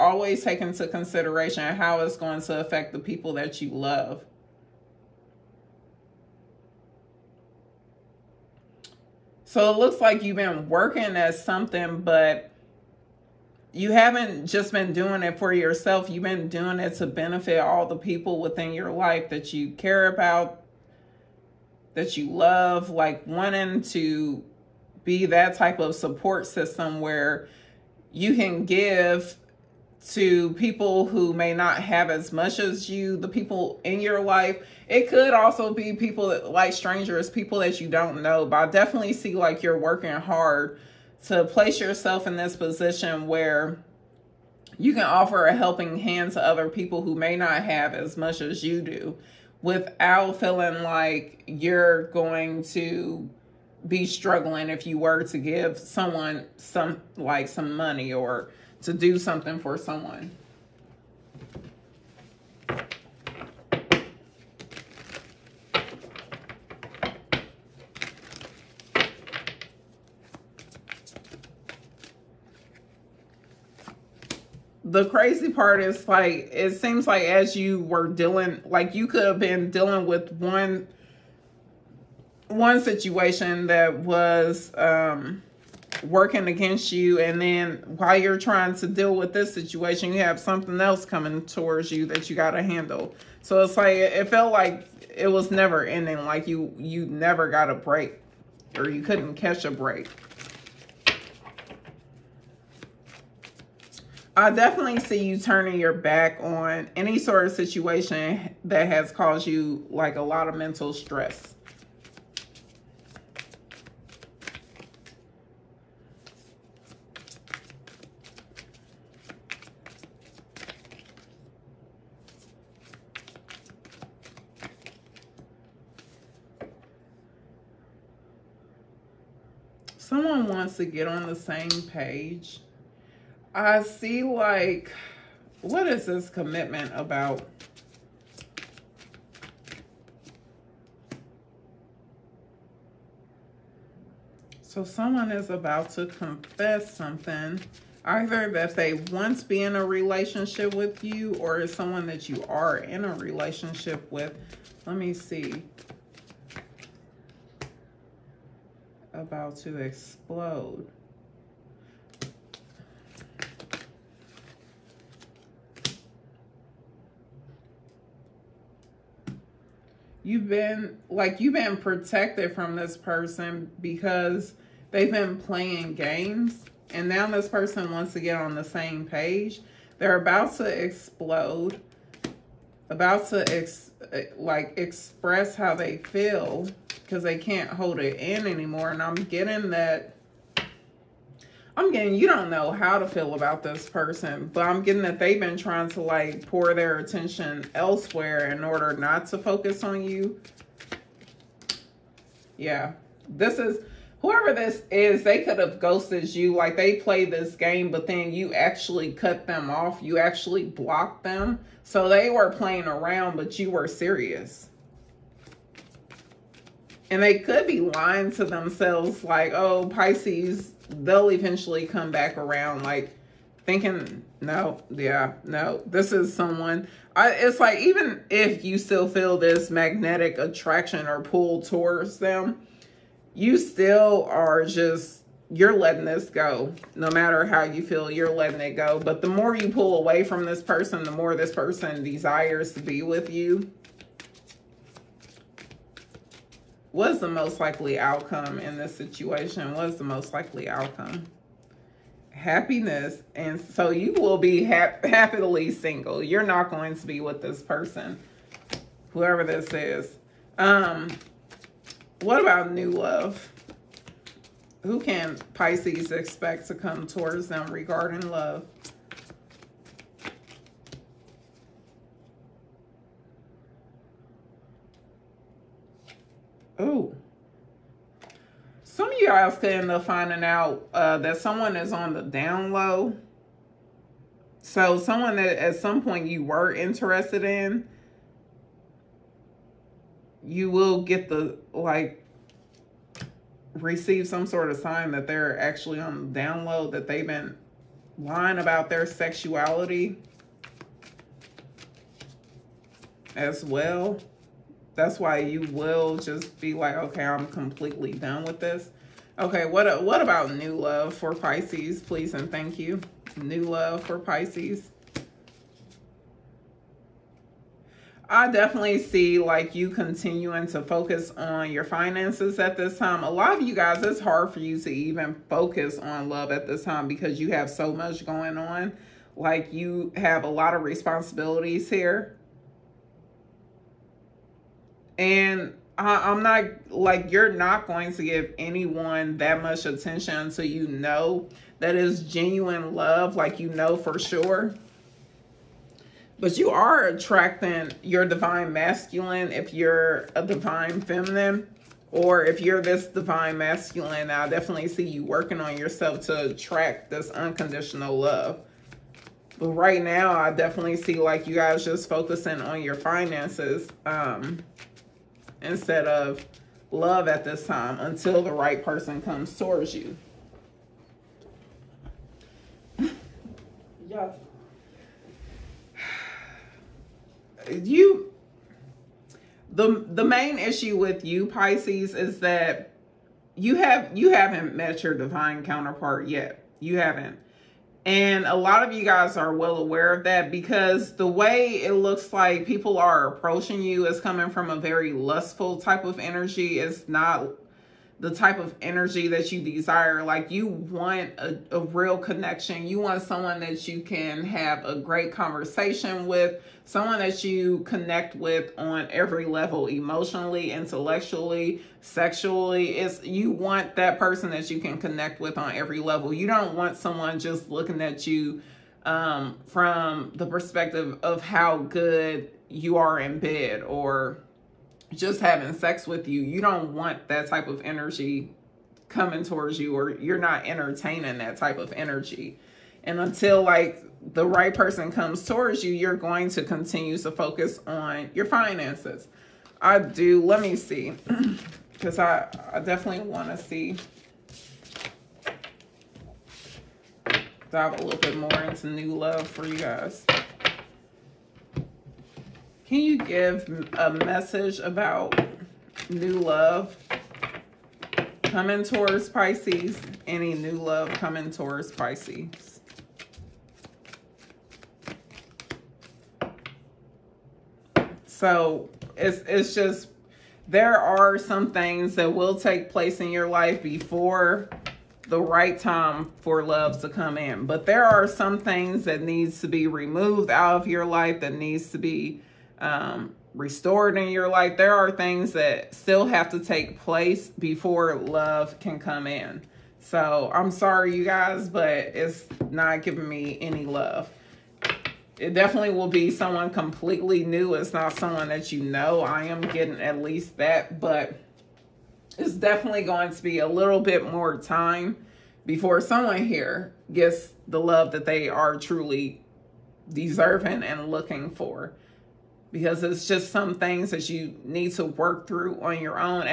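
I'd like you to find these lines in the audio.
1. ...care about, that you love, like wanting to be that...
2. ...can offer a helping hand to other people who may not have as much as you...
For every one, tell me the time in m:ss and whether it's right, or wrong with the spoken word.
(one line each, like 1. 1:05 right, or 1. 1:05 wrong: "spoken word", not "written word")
1. 0:19 right
2. 0:44 right.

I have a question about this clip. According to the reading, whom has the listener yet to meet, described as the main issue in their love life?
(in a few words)
divine counterpart.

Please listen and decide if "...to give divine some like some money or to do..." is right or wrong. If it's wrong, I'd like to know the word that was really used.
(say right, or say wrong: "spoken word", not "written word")
wrong: "someone", not "divine".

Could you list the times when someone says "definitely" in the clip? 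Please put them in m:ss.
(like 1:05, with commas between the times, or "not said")
0:38, 1:44, 5:18, 5:54, 6:00, 7:22, 8:15, 8:22.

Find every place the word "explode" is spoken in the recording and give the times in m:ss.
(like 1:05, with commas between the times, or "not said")
2:39, 3:00.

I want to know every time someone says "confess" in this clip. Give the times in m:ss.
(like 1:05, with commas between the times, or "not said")
2:26.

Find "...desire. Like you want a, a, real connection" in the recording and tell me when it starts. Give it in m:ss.
6:39.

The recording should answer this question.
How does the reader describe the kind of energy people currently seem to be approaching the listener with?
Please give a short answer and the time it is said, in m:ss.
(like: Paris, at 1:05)
lustful, at 6:35.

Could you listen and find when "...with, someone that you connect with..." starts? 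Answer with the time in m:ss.
6:46.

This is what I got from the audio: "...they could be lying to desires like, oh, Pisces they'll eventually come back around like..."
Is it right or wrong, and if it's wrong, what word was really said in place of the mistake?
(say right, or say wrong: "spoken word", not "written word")
wrong: "themselves", not "desires".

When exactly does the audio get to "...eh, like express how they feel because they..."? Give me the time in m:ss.
3:04.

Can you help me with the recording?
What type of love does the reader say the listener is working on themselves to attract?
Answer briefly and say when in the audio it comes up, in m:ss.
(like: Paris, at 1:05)
unconditional love, at 5:57.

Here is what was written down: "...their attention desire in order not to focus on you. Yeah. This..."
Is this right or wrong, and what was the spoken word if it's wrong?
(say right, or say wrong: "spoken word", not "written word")
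wrong: "elsewhere", not "desire".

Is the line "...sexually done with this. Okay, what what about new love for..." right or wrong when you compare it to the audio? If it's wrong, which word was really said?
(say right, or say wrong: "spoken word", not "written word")
wrong: "completely", not "sexually".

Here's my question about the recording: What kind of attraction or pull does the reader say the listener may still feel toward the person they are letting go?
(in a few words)
magnetic.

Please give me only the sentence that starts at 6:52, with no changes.
It's you want that person that you can connect with on every level.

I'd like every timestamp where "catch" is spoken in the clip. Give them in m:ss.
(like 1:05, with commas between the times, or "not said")
1:39.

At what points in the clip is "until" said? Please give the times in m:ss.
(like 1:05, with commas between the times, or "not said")
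5:40, 6:07, 7:13.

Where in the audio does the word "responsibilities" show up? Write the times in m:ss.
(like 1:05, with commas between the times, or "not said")
5:30.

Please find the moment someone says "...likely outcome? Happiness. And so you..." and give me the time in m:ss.
4:10.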